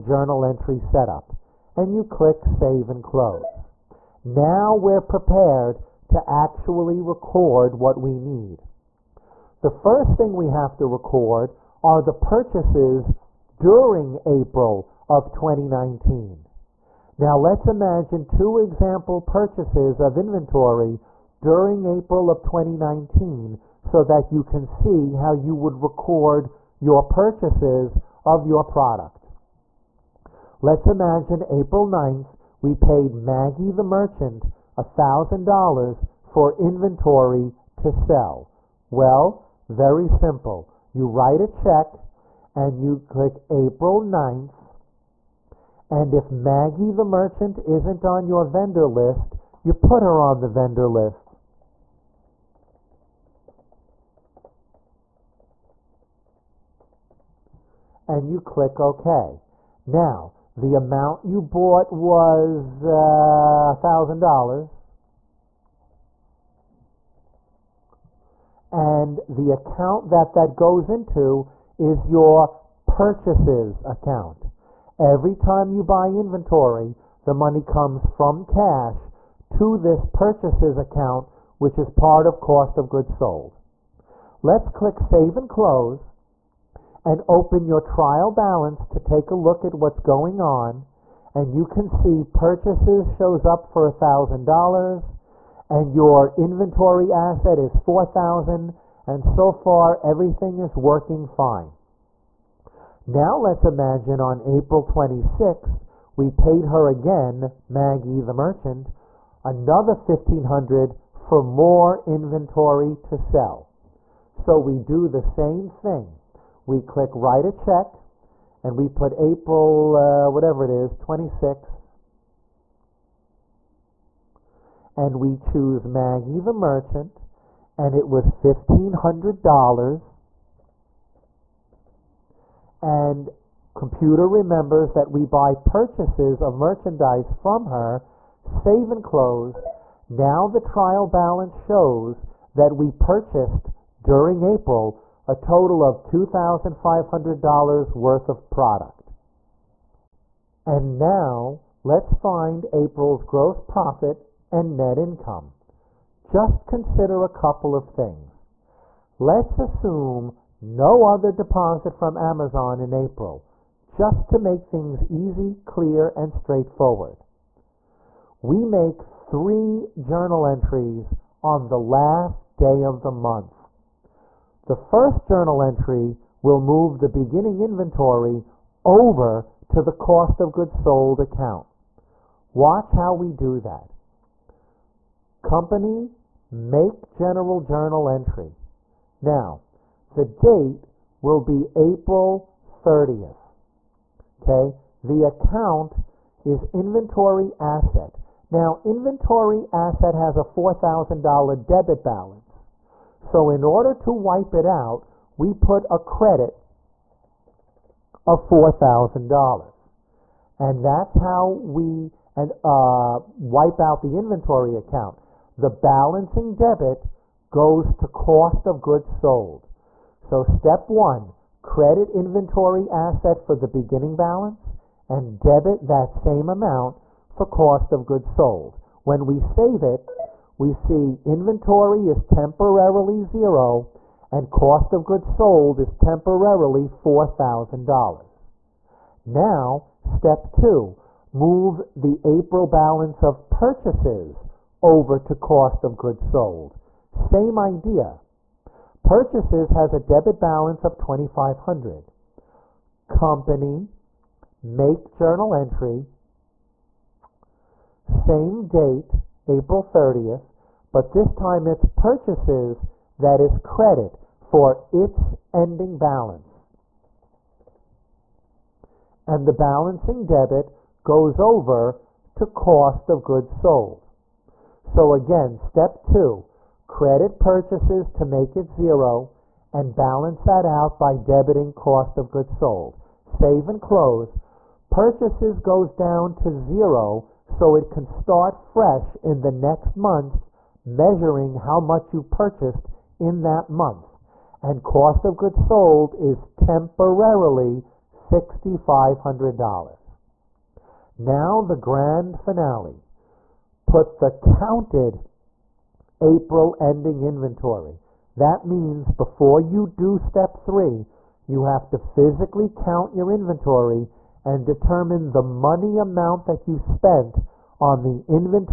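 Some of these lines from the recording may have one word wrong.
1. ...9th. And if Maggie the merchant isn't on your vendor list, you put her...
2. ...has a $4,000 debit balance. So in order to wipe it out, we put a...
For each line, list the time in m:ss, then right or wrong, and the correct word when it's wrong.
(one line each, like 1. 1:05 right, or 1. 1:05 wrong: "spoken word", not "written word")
1. 0:44 right
2. 3:20 right.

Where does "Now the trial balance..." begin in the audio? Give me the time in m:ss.
2:20.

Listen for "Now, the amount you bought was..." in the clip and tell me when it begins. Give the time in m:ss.
0:59.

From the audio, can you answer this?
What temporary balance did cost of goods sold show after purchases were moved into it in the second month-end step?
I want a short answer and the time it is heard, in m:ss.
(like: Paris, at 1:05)
$6,500, at 4:58.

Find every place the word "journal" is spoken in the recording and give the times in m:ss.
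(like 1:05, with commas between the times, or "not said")
2:49, 2:55, 3:07, 4:15.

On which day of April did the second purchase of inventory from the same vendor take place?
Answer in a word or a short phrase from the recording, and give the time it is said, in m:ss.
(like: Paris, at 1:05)
April 26th, at 1:44.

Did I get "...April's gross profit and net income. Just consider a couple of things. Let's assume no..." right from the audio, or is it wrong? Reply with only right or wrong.
right.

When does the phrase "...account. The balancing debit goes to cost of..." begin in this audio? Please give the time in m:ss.
3:34.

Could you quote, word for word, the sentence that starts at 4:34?
So again, step two, credit purchases to make it zero and balance that out by debiting cost of goods sold.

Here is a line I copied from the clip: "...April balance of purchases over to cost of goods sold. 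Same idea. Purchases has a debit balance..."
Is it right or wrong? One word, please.
right.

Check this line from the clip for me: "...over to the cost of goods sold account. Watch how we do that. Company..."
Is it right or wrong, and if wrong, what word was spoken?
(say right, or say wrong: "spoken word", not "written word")
right.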